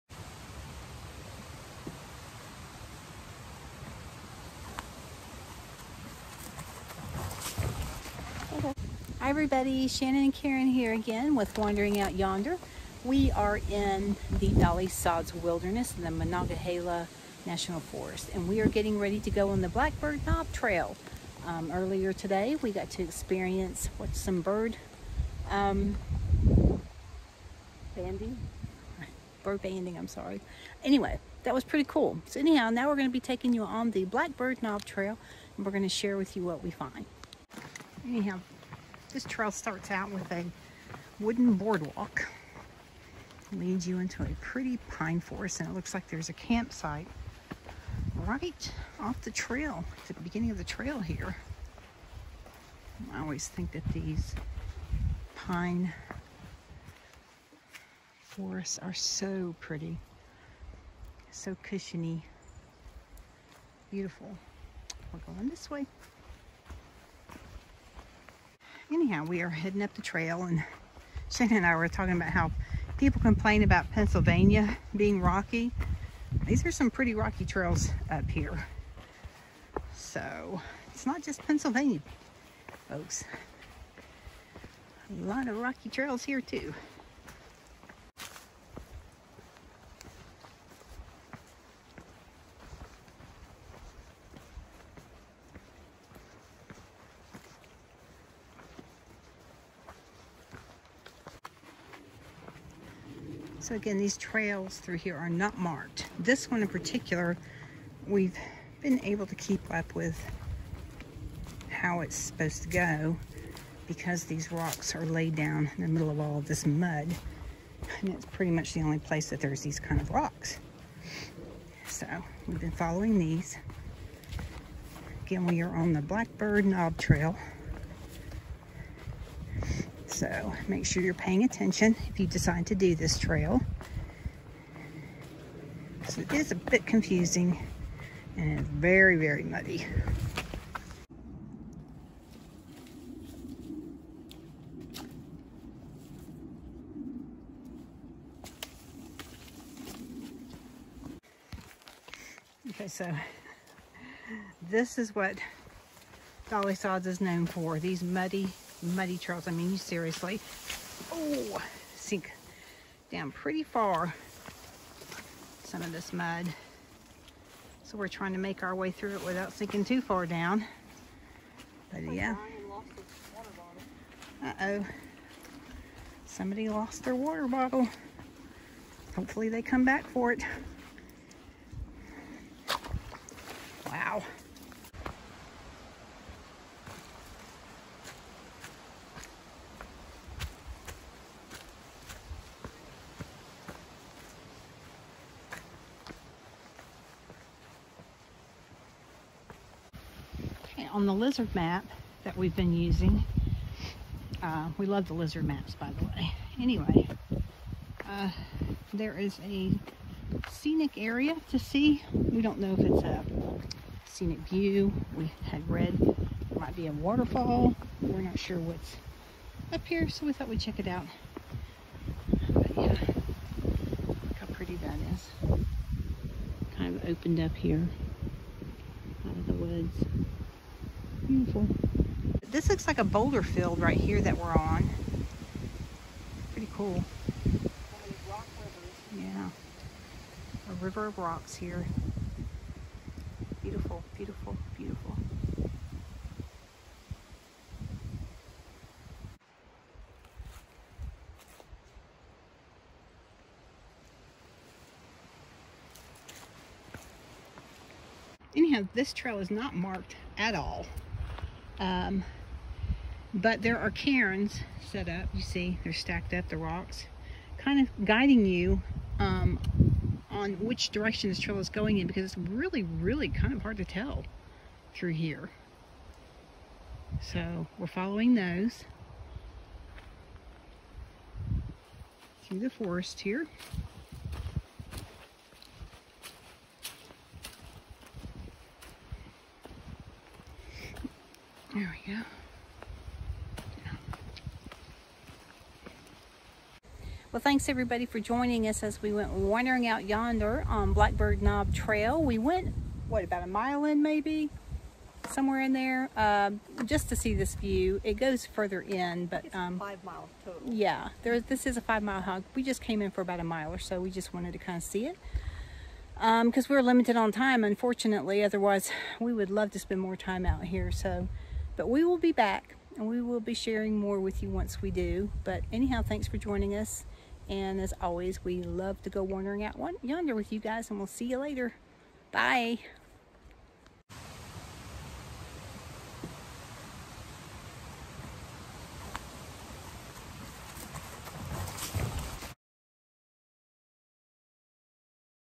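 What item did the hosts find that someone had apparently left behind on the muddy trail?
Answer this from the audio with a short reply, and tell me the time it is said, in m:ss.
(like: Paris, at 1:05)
water bottle, at 2:57.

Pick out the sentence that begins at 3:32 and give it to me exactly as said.
We don't know if it's a scenic view.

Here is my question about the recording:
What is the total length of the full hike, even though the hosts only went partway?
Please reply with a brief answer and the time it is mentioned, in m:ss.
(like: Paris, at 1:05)
5 miles, at 5:09.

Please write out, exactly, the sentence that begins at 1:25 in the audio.
A lot of rocky trails here too.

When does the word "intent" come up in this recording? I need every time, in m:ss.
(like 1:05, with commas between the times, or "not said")
not said.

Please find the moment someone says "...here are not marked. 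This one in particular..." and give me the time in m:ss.
1:44.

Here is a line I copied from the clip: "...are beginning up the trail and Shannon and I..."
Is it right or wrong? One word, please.
wrong.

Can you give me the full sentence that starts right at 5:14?
We just wanted to kind of see it because um, we we're limited on time, unfortunately.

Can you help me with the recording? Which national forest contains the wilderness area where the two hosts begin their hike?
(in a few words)
Monongahela National Forest.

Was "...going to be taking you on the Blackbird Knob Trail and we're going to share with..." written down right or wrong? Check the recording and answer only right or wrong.
right.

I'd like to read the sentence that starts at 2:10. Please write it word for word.
So make sure you're paying attention if you decide to do this trail.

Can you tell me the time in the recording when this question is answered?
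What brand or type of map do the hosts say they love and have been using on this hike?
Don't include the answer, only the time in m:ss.
3:21.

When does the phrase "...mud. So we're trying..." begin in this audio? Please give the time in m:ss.
2:46.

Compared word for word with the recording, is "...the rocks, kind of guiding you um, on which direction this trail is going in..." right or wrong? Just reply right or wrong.
right.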